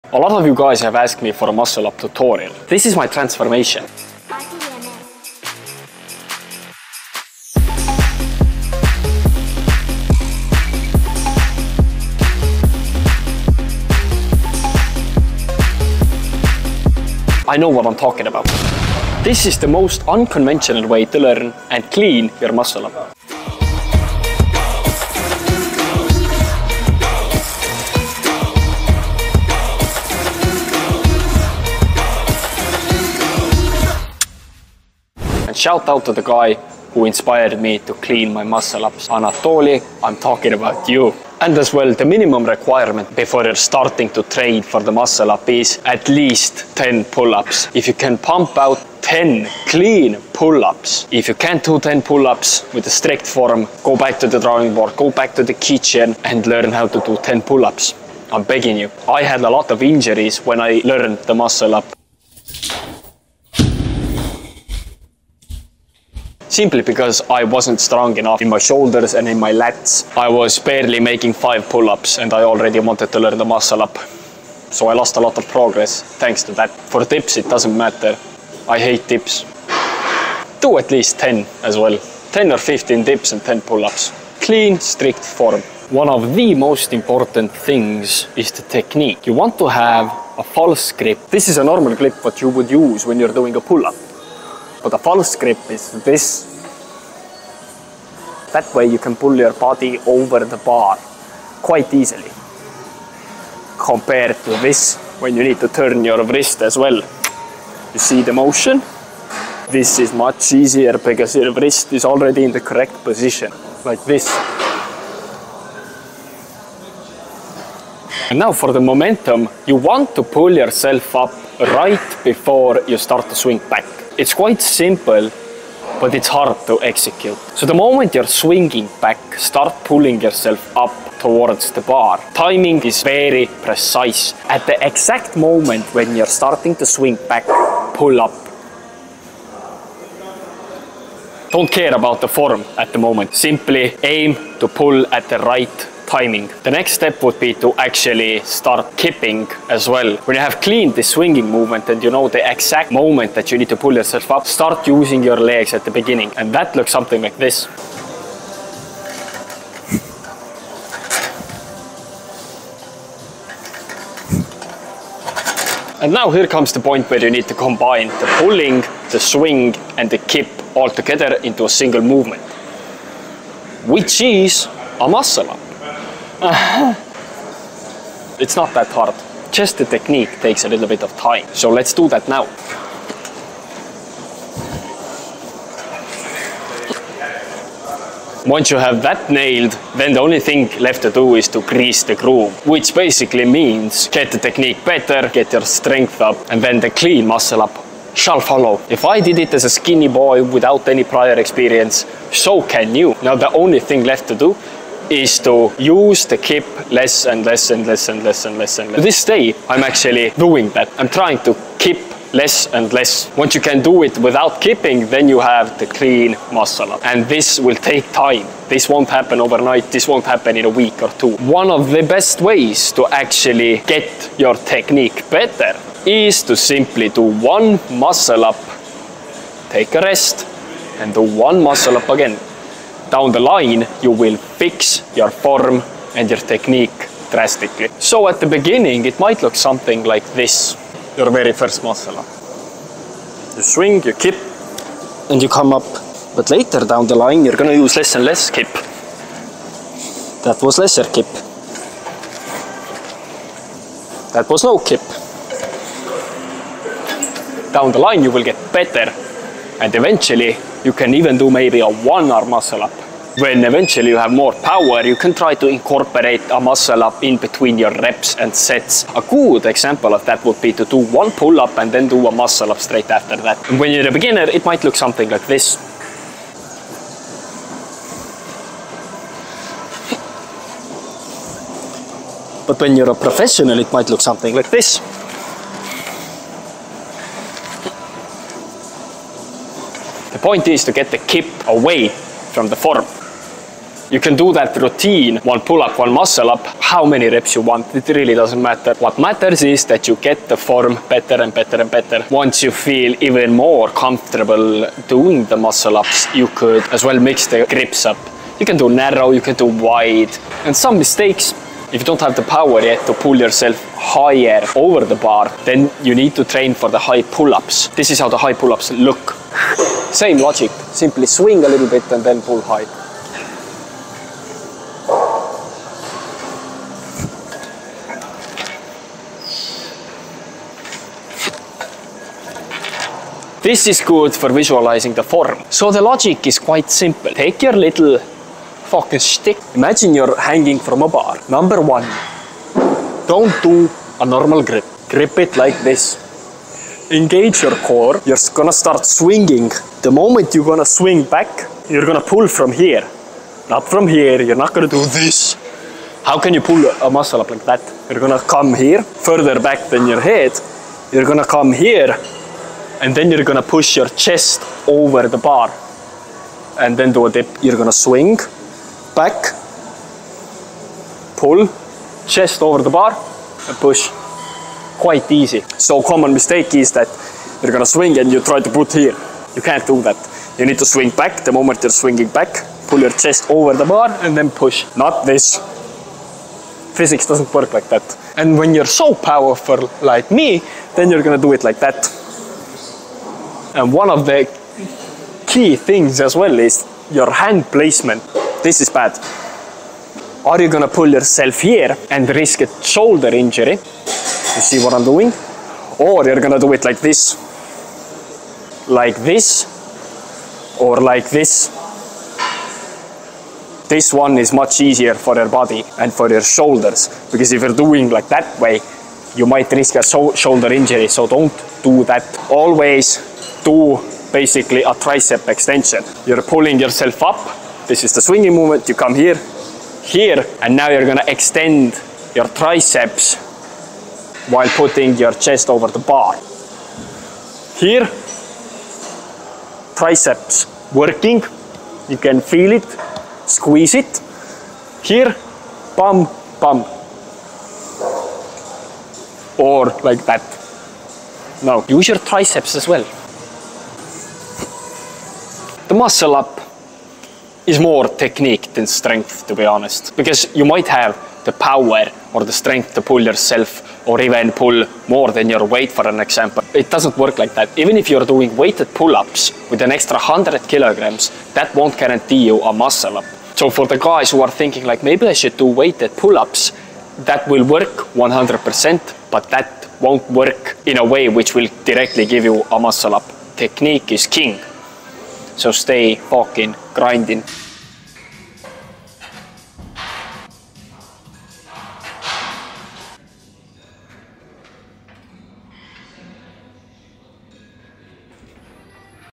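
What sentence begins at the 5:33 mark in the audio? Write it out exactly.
This is good for visualizing the form.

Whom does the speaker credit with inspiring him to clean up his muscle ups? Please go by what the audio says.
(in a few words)
Anatoly.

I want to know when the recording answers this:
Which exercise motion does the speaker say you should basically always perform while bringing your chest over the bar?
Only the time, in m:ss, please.
7:04.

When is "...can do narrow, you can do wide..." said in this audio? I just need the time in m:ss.
5:08.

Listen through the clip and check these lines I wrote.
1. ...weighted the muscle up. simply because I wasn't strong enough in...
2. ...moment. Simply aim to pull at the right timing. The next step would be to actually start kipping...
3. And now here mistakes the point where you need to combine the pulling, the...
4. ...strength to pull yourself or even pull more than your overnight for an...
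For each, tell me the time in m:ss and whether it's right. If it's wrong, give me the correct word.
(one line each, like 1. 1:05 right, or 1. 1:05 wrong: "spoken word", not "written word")
1. 1:00 wrong: "learned", not "weighted"
2. 2:22 right
3. 2:46 wrong: "comes", not "mistakes"
4. 7:42 wrong: "weight", not "overnight".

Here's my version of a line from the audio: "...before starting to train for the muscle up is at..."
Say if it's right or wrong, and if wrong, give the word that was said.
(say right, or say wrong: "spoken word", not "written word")
right.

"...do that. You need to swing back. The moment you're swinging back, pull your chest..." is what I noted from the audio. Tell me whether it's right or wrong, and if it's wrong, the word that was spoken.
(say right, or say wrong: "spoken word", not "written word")
right.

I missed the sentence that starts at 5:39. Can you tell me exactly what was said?
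Imagine you're hanging from a bar.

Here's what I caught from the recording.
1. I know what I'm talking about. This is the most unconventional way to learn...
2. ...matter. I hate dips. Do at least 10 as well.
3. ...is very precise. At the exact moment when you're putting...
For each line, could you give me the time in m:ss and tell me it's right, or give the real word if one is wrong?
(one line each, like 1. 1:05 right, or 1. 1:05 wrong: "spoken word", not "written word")
1. 0:17 right
2. 1:17 right
3. 2:12 wrong: "starting", not "putting".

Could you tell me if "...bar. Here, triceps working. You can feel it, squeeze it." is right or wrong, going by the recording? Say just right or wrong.
right.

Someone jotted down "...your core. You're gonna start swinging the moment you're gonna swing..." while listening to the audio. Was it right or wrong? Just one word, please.
right.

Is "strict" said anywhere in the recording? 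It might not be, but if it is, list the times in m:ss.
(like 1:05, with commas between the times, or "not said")
0:52, 1:24.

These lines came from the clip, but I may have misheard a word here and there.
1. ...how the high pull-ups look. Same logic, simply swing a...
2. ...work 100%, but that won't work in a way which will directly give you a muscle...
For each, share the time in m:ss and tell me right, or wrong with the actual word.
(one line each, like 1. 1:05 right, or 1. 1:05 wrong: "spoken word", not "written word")
1. 5:18 right
2. 7:57 right.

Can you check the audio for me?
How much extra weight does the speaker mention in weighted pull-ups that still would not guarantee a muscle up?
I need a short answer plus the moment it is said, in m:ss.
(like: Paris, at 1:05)
100 kilograms, at 7:50.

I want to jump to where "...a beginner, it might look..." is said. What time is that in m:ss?
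4:34.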